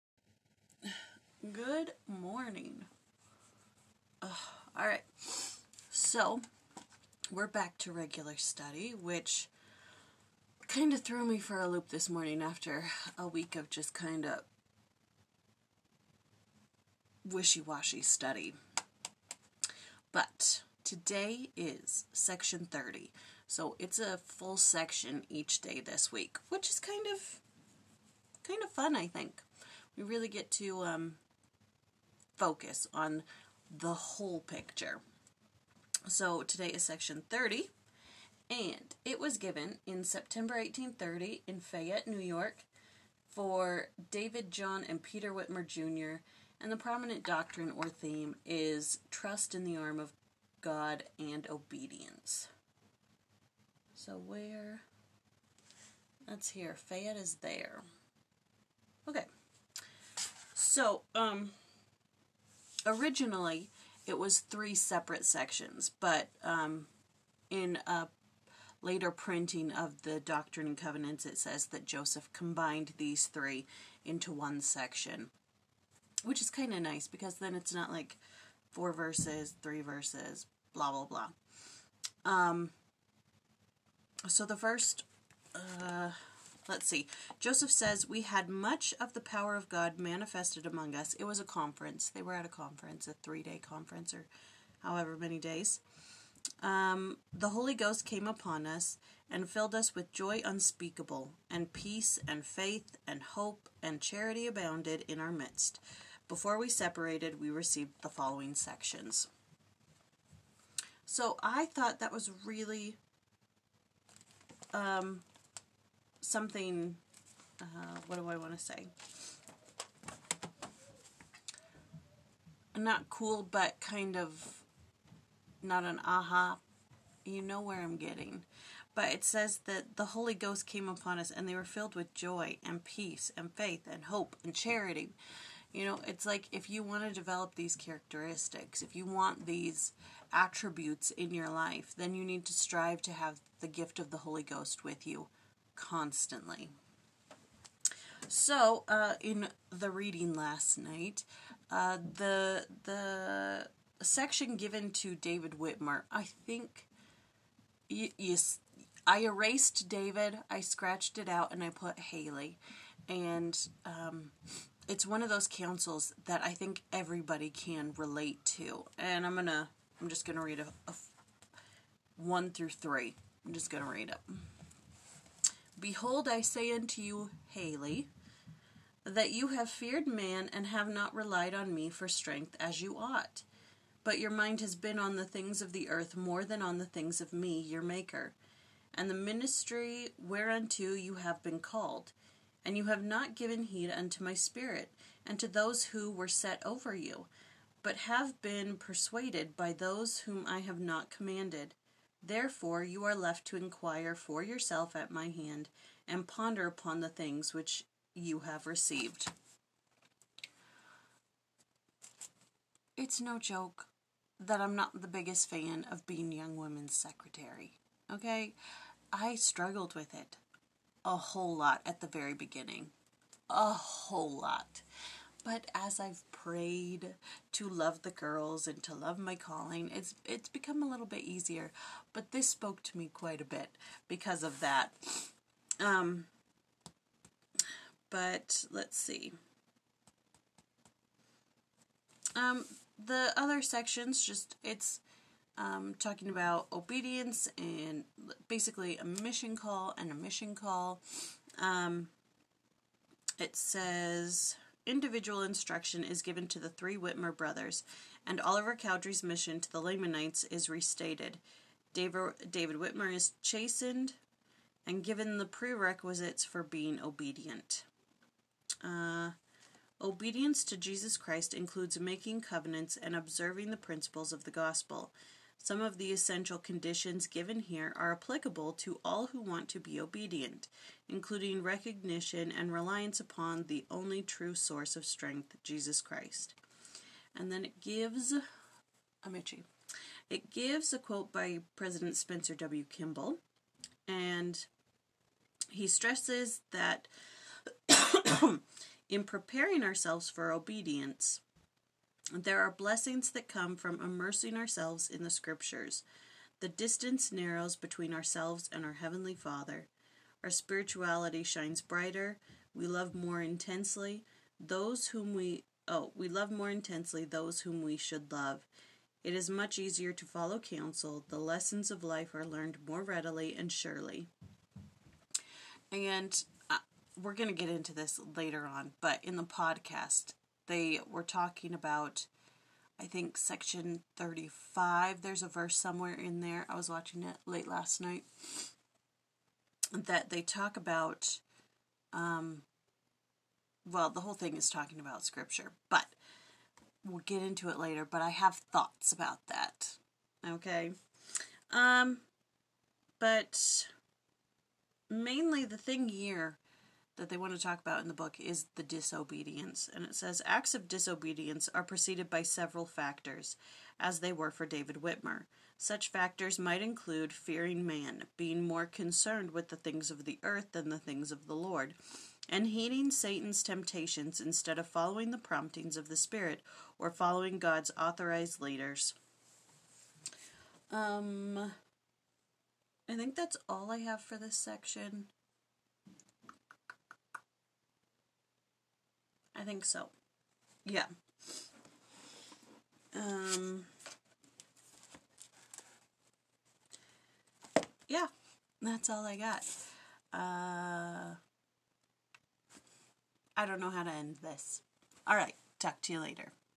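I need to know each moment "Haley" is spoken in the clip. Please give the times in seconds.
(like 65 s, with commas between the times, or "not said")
161 s, 177 s.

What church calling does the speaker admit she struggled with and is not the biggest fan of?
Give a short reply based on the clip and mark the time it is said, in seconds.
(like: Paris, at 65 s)
Young women's secretary, at 216 s.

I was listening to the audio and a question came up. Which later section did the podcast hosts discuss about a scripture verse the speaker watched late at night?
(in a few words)
Section 35.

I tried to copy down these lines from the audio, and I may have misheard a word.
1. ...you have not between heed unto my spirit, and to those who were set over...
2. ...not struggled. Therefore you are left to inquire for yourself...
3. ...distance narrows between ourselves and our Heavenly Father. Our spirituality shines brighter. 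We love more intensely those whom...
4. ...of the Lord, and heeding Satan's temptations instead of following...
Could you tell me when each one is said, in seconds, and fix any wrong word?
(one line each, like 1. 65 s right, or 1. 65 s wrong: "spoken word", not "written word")
1. 192 s wrong: "given", not "between"
2. 200 s wrong: "commanded", not "struggled"
3. 306 s right
4. 371 s right.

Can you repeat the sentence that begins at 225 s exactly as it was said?
But as I've prayed to love the girls and to love my calling, it's it's become a little bit easier.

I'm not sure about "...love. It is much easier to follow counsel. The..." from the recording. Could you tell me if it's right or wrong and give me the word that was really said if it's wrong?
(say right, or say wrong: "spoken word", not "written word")
right.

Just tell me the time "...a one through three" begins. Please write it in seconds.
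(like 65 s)
170 s.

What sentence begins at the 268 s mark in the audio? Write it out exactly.
Uh, obedience to Jesus Christ includes making covenants and observing the principles of the gospel.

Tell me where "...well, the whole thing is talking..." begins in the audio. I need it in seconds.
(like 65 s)
343 s.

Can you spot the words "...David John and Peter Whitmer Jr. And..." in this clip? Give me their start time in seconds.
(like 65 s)
44 s.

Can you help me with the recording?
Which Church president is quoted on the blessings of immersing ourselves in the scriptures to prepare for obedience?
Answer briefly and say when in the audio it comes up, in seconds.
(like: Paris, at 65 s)
Spencer W. Kimball, at 292 s.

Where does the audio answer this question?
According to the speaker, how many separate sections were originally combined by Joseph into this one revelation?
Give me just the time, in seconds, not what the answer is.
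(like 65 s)
64 s.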